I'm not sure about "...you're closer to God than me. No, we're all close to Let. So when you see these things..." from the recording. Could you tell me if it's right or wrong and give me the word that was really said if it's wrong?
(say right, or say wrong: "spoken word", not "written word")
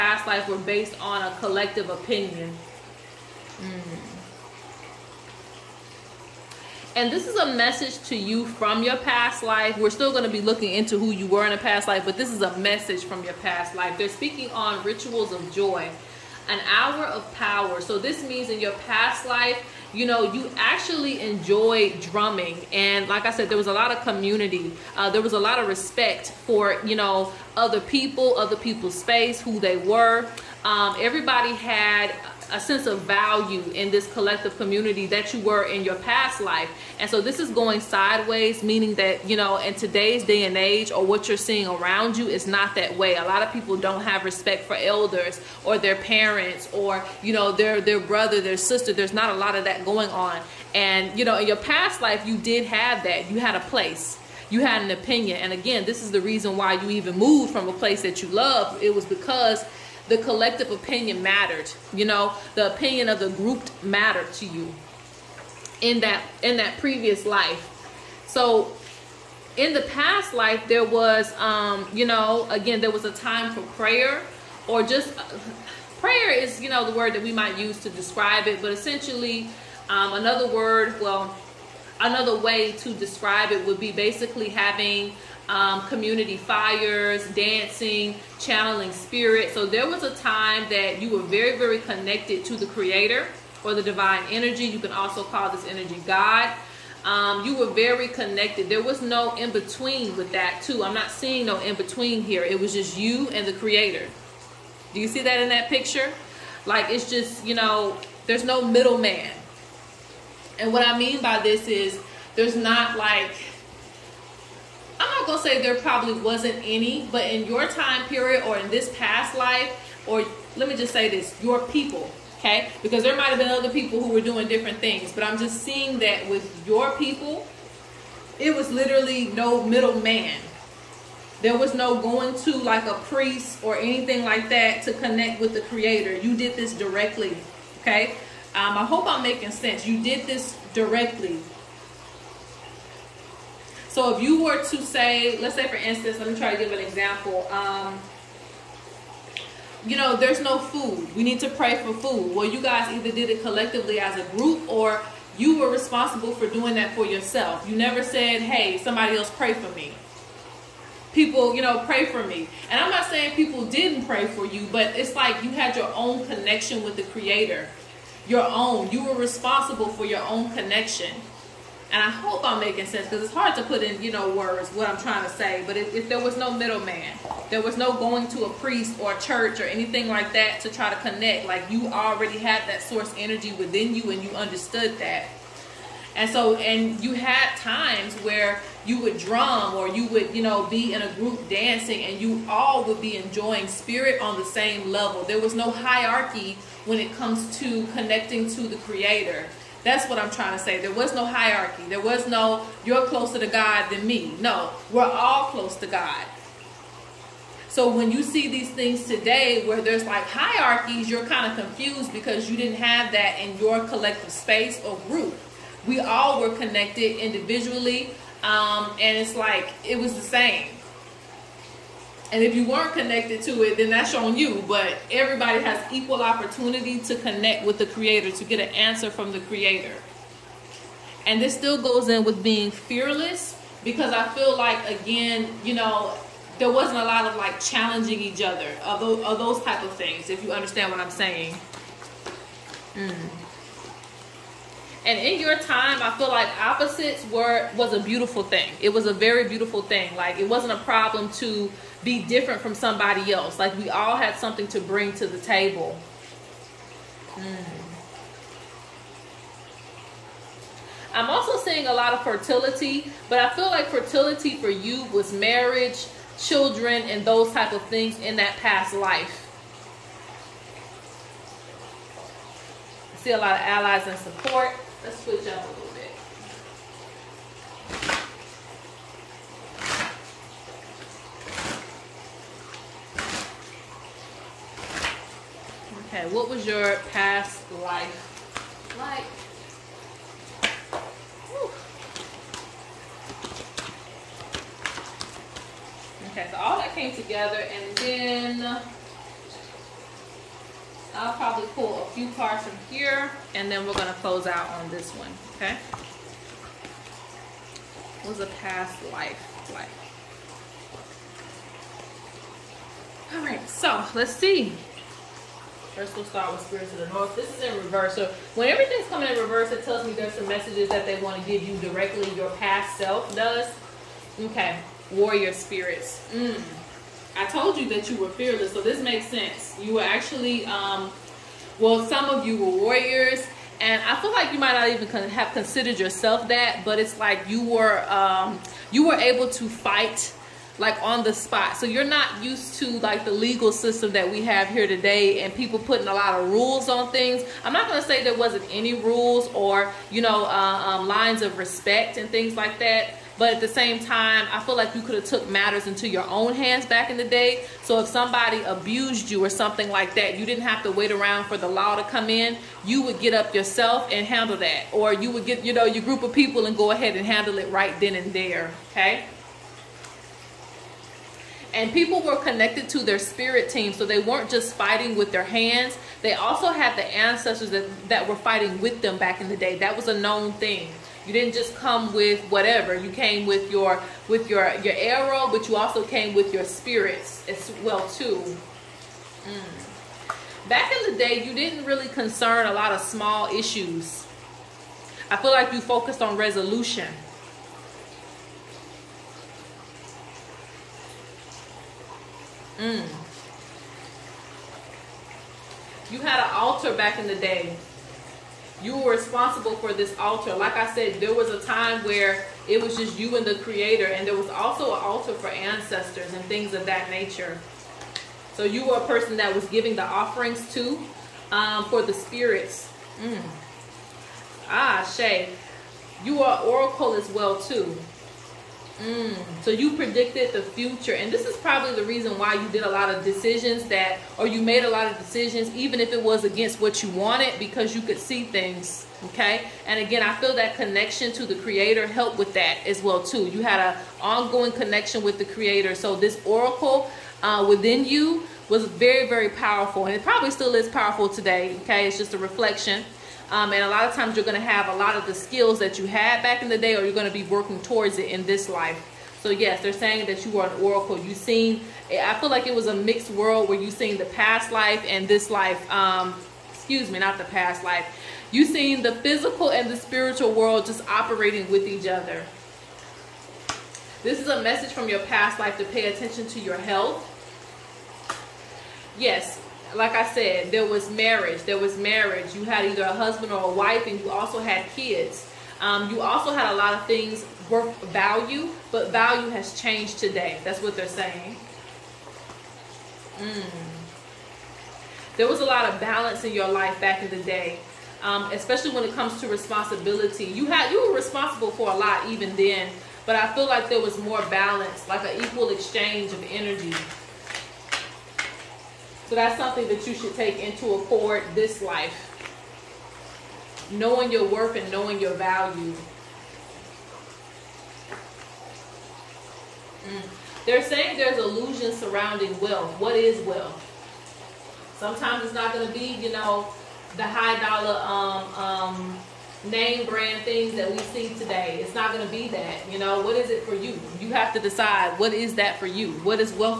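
wrong: "God", not "Let".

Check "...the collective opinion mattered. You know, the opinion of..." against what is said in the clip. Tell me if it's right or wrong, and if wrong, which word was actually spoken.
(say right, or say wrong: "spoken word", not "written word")
right.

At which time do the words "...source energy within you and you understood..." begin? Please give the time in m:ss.
3:02.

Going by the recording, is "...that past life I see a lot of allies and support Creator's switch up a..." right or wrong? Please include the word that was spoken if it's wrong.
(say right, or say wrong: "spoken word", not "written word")
wrong: "Let", not "Creator".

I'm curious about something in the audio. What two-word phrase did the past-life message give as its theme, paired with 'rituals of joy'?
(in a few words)
hour of power.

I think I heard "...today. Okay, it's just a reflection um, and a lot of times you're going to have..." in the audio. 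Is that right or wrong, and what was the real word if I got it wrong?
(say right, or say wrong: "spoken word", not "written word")
right.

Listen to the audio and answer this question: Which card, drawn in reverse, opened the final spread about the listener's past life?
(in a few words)
Spirits of the North.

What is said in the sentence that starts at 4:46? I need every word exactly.
Okay, what was your past life like?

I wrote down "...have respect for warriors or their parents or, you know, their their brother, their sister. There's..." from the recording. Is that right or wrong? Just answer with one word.
wrong.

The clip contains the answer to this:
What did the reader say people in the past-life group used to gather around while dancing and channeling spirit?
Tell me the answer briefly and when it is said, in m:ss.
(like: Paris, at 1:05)
community fires, at 1:25.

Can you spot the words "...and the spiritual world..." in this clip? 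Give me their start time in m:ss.
7:49.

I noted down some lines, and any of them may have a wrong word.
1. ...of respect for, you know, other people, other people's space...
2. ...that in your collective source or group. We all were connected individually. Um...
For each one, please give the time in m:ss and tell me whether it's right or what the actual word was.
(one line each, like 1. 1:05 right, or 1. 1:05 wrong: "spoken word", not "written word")
1. 0:25 right
2. 3:33 wrong: "space", not "source".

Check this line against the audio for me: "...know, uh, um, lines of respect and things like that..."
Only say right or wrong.
right.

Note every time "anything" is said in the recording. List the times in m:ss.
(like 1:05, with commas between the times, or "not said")
2:13, 2:59.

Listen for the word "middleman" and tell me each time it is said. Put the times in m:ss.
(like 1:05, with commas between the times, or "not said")
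1:48, 2:09, 2:56.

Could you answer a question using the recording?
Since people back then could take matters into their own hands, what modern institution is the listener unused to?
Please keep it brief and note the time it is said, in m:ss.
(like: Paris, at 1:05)
legal system, at 5:43.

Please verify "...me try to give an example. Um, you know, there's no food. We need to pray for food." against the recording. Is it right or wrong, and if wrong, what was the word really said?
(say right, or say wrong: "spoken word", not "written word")
right.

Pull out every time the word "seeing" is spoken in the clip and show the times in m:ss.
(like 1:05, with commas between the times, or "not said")
0:41, 1:41, 2:05, 4:21.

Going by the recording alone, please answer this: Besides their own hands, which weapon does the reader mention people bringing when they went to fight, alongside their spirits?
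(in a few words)
arrow.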